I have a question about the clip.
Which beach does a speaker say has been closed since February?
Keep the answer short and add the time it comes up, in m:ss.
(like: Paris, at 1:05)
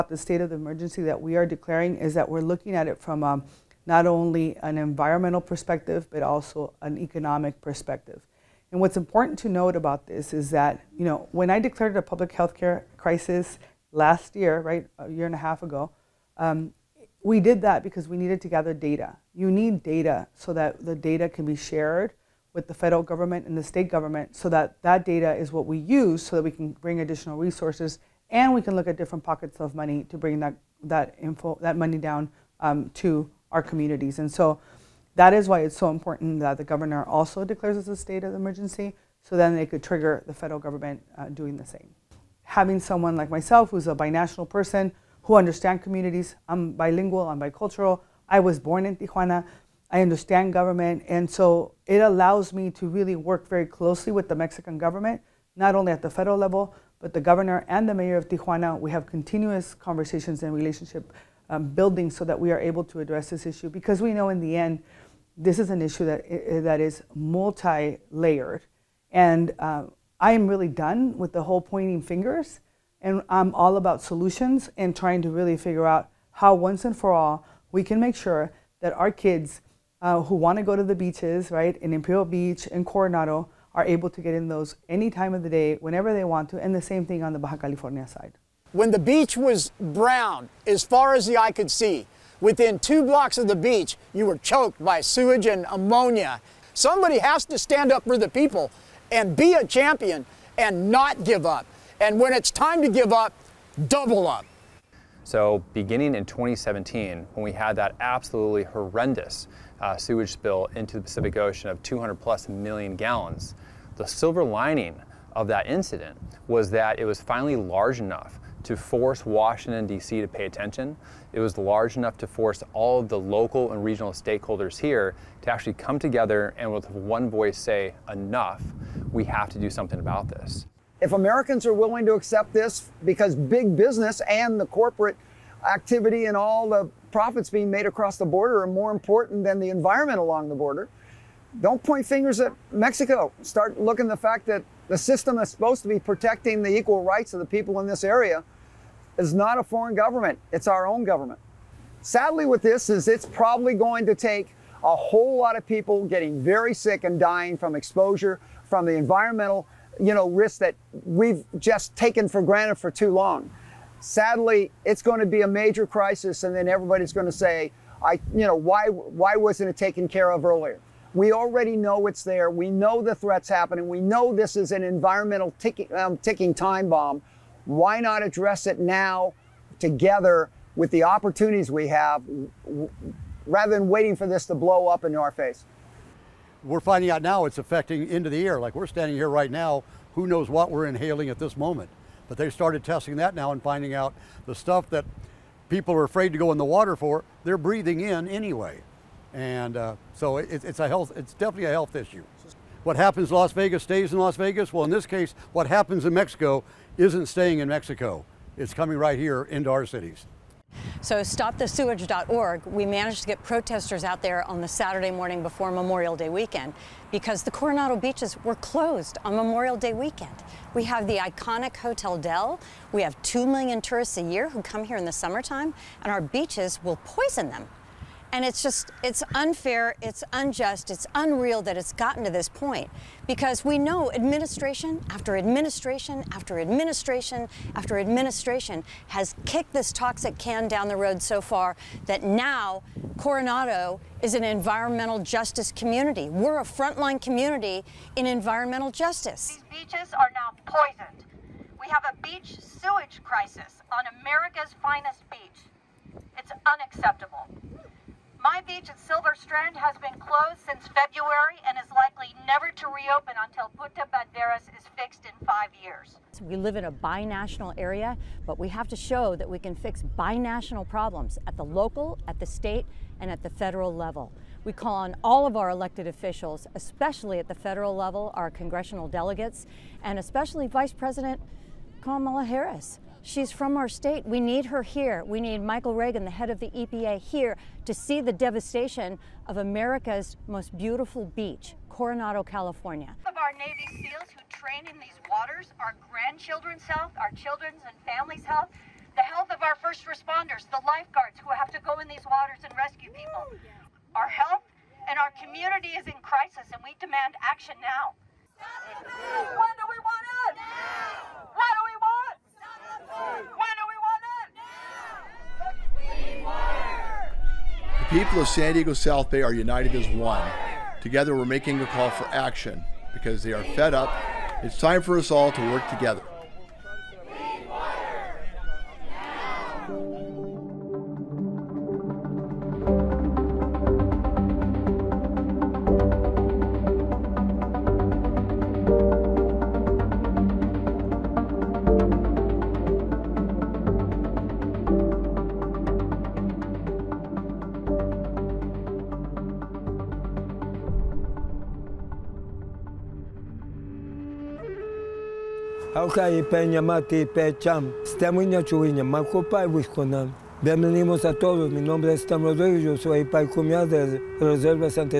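Silver Strand, at 4:18.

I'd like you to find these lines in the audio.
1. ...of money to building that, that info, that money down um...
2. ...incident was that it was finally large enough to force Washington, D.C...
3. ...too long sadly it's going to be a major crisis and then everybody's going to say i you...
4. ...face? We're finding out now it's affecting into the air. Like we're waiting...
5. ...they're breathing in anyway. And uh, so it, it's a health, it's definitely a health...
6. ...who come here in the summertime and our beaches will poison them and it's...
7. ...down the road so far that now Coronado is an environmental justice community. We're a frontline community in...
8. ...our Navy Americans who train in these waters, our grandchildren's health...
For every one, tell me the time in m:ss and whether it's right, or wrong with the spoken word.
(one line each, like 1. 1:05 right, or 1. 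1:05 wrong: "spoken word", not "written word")
1. 0:29 wrong: "bring", not "building"
2. 1:55 right
3. 2:42 right
4. 3:05 wrong: "standing", not "waiting"
5. 3:17 right
6. 3:44 right
7. 4:00 right
8. 4:53 wrong: "SEALs", not "Americans".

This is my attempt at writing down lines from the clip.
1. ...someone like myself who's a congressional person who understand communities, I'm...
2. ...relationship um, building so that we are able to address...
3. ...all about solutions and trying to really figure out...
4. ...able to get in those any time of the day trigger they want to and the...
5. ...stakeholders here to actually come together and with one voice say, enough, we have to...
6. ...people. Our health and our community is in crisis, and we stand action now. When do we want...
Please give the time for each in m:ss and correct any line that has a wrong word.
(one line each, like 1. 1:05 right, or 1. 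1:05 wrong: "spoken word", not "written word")
1. 0:42 wrong: "binational", not "congressional"
2. 1:00 right
3. 1:13 right
4. 1:23 wrong: "whenever", not "trigger"
5. 2:04 right
6. 5:03 wrong: "demand", not "stand".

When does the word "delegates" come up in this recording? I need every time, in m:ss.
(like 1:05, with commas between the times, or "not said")
4:39.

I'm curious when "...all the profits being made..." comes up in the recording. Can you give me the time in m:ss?
2:16.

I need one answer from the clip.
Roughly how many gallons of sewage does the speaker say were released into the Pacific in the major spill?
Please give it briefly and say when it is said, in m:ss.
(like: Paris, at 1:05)
200 million, at 1:51.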